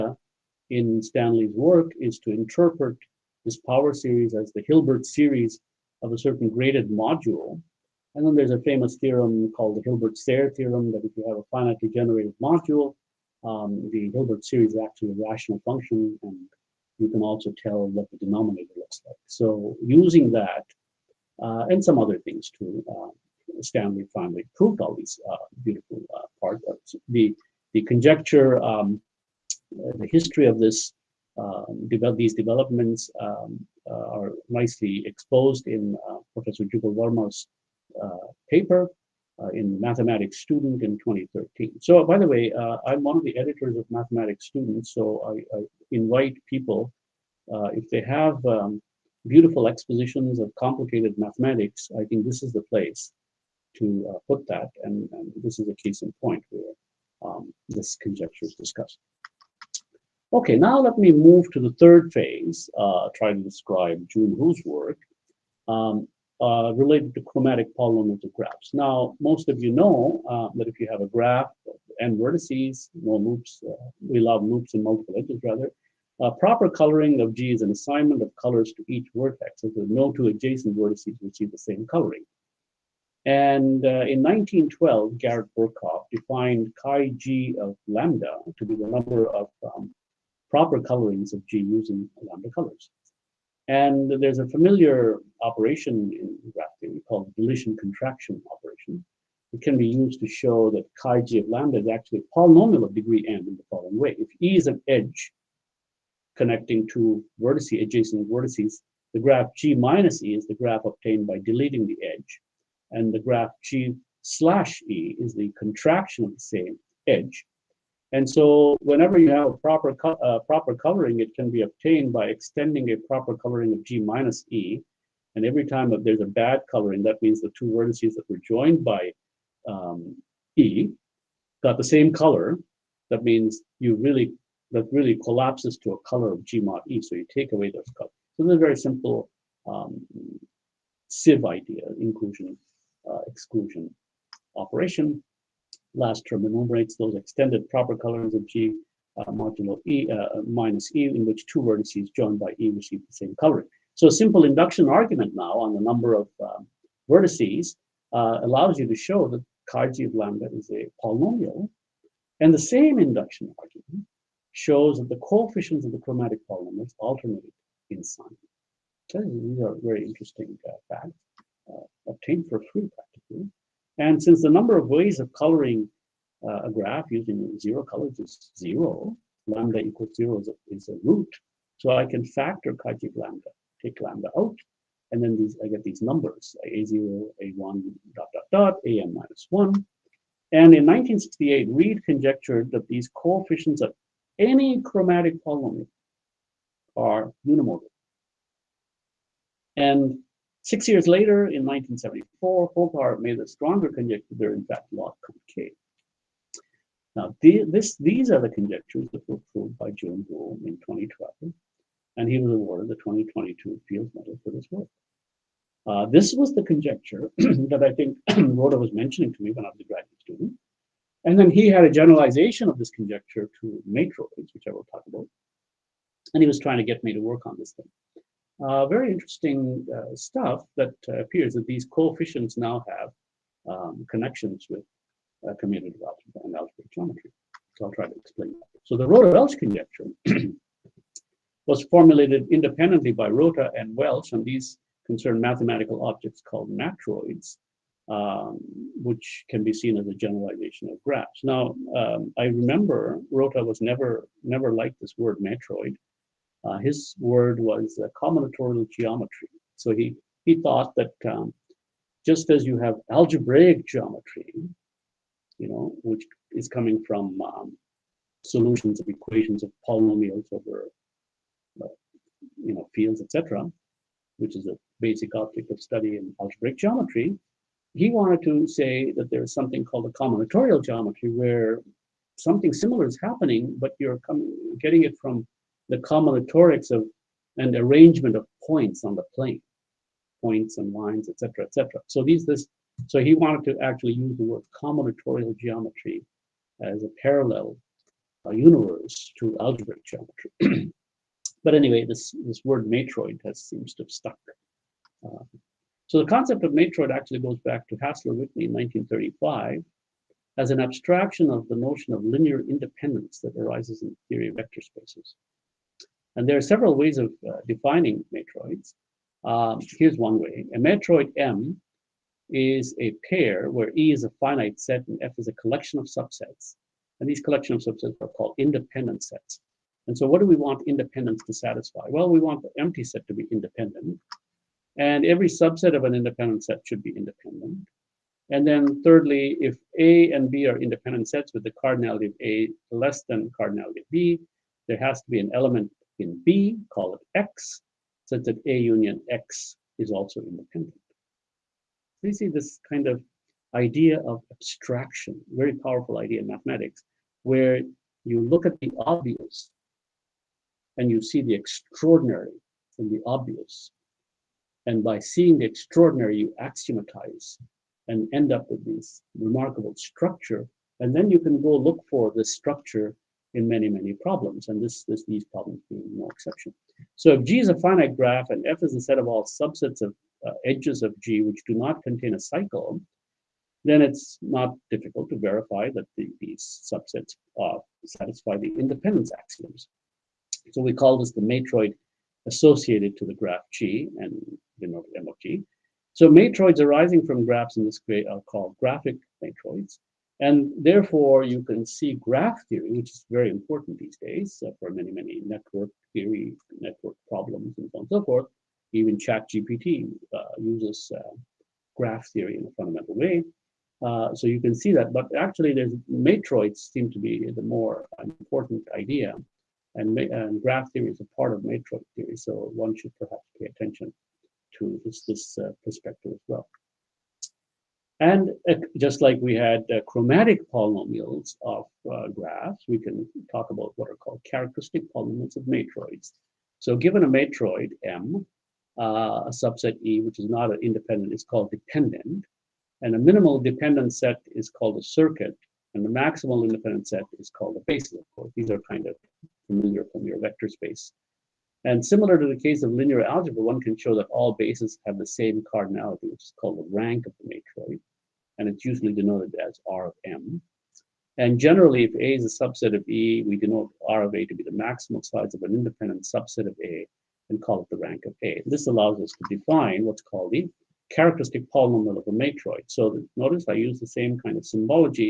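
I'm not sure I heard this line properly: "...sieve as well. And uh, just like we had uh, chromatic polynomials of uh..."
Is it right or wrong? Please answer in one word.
wrong.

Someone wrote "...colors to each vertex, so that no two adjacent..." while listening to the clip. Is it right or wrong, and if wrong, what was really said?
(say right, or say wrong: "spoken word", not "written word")
right.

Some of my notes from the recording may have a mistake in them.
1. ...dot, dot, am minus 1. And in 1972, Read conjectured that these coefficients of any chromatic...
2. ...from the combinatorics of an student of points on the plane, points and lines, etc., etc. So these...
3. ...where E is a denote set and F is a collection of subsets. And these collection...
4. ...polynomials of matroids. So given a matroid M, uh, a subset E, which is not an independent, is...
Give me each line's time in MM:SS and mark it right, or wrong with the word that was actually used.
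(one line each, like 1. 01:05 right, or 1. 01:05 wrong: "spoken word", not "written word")
1. 03:08 wrong: "1968", not "1972"
2. 04:45 wrong: "arrangement", not "student"
3. 05:23 wrong: "finite", not "denote"
4. 07:15 right.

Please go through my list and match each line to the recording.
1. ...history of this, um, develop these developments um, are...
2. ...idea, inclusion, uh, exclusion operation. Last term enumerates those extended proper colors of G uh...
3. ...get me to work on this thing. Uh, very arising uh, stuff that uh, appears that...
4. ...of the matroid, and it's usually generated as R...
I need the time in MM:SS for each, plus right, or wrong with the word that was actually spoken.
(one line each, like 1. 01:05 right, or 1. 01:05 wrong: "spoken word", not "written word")
1. 00:30 right
2. 02:21 right
3. 03:46 wrong: "interesting", not "arising"
4. 07:37 wrong: "denoted", not "generated".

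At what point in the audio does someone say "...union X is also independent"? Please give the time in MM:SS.
05:48.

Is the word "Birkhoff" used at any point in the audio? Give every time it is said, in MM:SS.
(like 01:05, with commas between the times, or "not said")
01:25.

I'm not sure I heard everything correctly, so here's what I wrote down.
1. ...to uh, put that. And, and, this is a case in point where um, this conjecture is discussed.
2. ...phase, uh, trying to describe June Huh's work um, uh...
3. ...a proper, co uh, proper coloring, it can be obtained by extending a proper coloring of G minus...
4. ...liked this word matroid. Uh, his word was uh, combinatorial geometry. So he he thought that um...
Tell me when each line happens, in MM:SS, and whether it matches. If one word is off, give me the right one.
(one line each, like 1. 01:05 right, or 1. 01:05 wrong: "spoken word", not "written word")
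1. 00:53 right
2. 01:02 right
3. 01:59 right
4. 04:14 right.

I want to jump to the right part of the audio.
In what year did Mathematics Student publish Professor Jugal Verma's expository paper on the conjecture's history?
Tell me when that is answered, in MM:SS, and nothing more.
00:40.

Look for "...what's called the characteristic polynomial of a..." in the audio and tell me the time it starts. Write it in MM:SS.
07:50.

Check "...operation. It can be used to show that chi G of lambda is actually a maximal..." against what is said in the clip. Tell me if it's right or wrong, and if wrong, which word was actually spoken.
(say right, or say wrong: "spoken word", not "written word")
wrong: "polynomial", not "maximal".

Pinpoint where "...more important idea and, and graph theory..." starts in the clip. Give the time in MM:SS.
06:57.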